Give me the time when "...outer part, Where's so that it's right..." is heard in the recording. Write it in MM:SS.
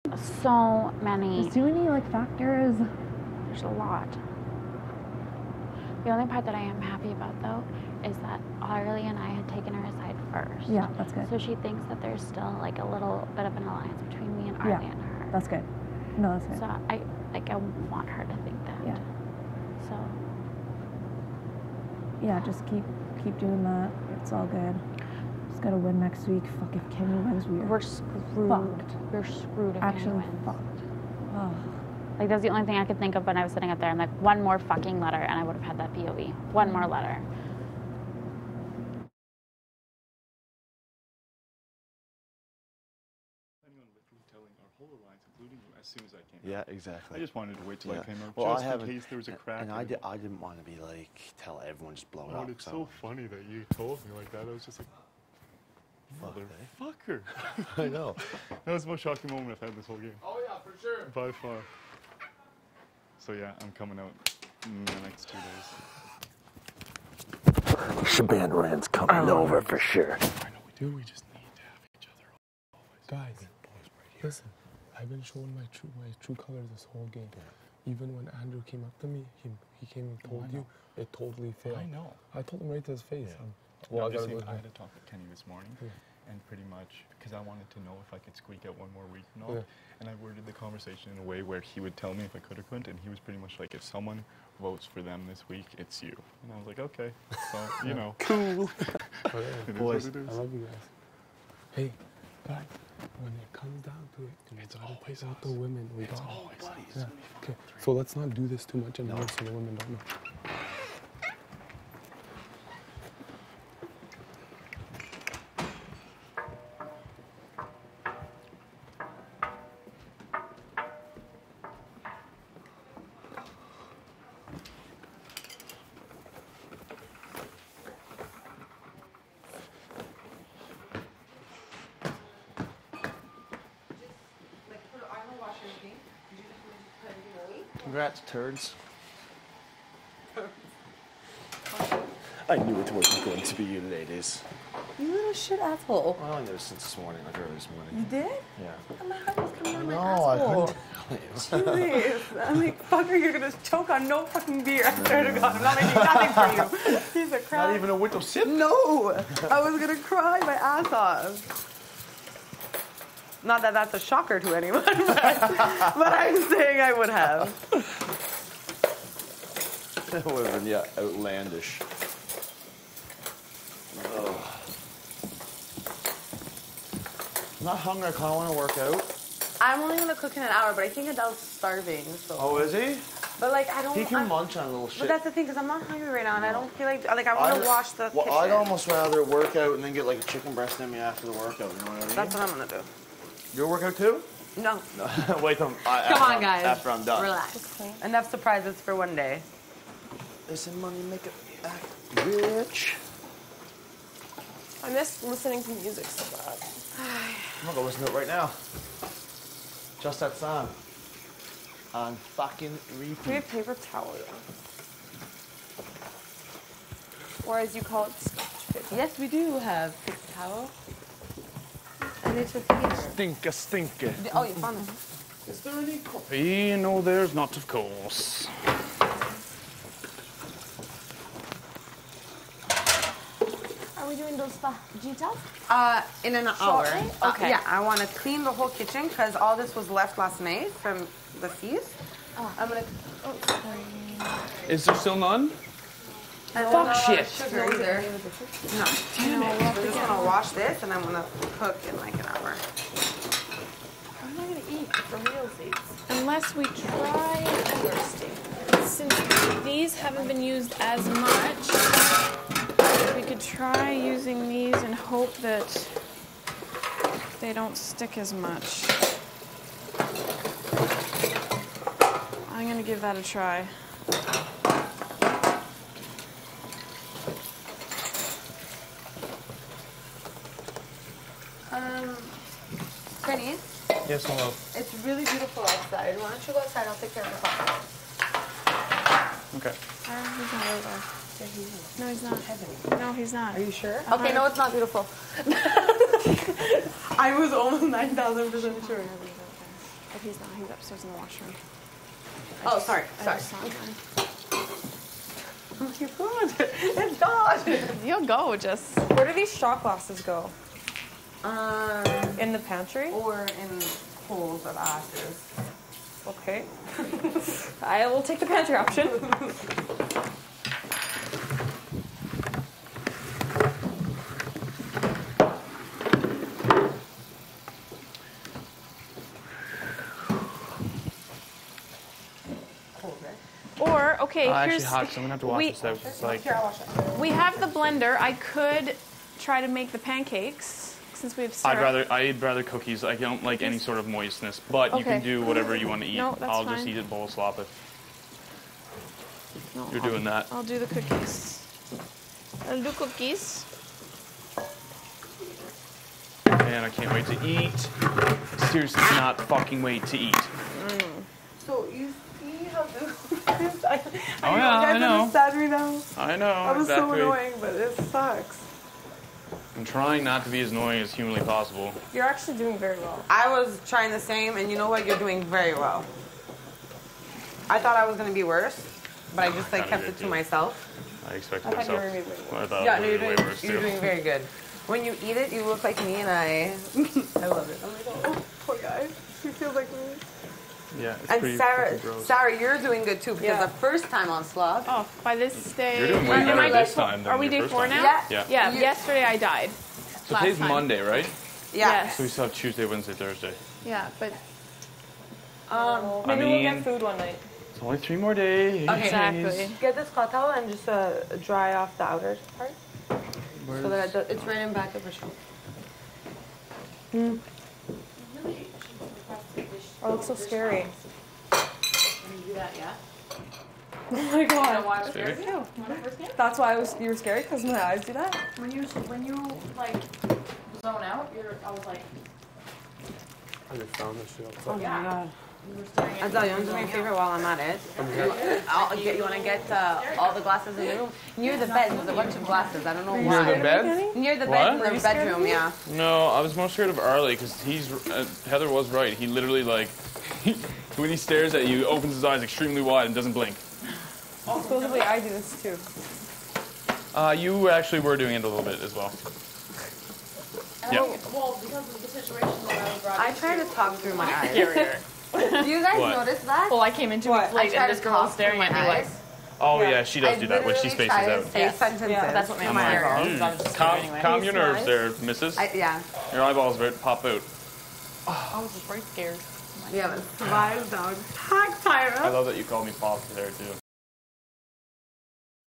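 06:52.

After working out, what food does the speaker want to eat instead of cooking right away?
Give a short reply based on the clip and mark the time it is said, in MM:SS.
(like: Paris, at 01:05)
chicken breast, at 03:10.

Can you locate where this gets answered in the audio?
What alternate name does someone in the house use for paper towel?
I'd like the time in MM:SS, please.
03:38.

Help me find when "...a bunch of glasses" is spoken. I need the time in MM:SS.
07:22.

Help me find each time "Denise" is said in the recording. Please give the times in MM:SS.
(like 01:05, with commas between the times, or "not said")
04:43.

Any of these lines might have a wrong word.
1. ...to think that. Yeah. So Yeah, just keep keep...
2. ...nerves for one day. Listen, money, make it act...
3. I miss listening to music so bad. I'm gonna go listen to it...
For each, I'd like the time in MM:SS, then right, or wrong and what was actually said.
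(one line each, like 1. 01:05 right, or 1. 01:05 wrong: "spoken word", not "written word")
1. 00:18 right
2. 03:18 wrong: "surprises", not "nerves"
3. 03:24 right.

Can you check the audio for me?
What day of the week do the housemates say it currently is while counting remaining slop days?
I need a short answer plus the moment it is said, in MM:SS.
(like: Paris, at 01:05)
Monday, at 06:40.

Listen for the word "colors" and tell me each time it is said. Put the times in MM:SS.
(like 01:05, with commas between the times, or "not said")
01:16.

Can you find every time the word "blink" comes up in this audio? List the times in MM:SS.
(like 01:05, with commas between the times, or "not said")
07:33.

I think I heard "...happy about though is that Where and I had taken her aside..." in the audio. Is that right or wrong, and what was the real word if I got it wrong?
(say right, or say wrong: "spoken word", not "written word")
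wrong: "Arlie", not "Where".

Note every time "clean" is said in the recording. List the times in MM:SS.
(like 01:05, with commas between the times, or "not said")
03:58.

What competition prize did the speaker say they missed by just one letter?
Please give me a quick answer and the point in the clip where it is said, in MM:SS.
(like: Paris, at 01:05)
POV, at 00:35.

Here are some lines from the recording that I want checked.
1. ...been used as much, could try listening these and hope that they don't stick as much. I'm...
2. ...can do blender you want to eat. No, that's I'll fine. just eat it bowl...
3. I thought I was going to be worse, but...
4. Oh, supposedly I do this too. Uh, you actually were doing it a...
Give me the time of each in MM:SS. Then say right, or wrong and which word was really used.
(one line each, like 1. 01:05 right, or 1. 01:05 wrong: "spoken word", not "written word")
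1. 04:20 wrong: "using", not "listening"
2. 05:45 wrong: "whatever", not "blender"
3. 06:17 right
4. 07:34 right.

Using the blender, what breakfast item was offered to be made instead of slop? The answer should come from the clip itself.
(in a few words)
pancakes.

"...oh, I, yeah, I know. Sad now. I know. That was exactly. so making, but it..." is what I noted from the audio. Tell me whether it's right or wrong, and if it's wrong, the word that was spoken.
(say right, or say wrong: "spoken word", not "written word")
wrong: "annoying", not "making".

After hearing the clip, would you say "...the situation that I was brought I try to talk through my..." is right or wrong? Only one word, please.
right.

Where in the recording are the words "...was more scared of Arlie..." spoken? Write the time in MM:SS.
07:26.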